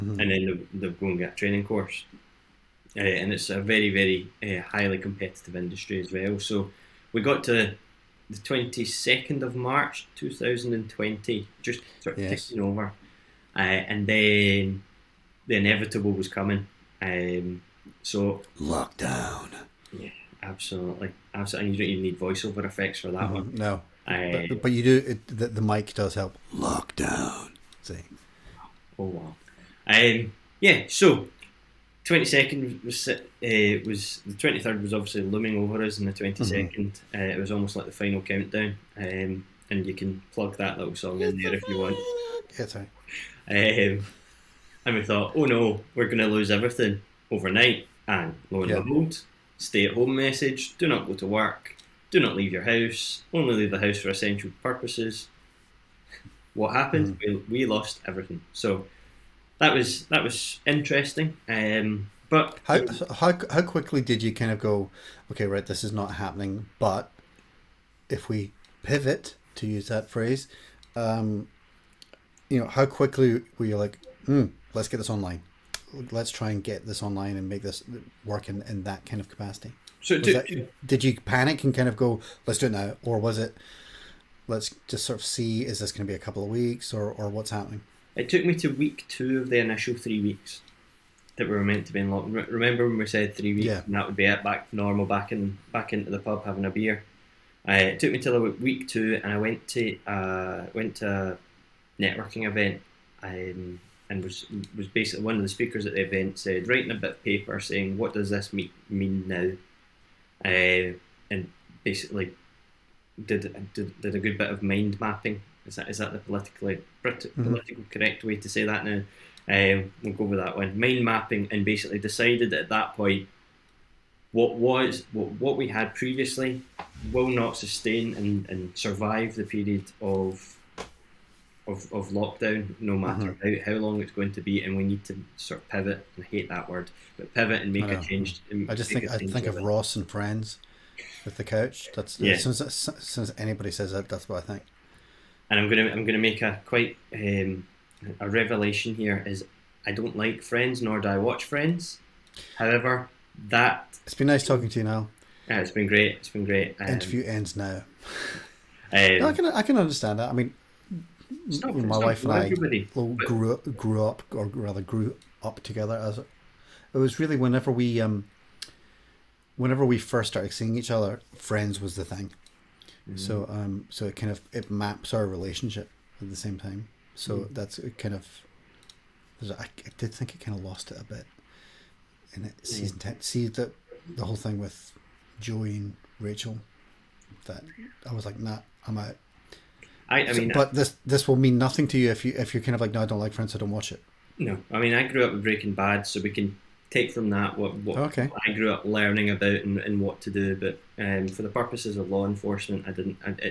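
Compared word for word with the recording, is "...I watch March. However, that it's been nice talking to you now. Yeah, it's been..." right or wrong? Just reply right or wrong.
wrong.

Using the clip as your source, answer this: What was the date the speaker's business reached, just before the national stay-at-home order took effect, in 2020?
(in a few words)
22nd of March 2020.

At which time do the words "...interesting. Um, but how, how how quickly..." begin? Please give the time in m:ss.
1:00.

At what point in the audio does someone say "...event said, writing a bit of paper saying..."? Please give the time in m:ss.
1:46.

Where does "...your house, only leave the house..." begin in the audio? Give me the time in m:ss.
0:52.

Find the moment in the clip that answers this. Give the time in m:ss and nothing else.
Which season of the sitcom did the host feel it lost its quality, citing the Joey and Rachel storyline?
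3:02.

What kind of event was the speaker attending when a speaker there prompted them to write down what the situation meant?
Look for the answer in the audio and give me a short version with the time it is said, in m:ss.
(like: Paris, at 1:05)
A networking event, at 1:42.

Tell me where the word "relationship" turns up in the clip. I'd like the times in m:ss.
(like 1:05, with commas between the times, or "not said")
2:55.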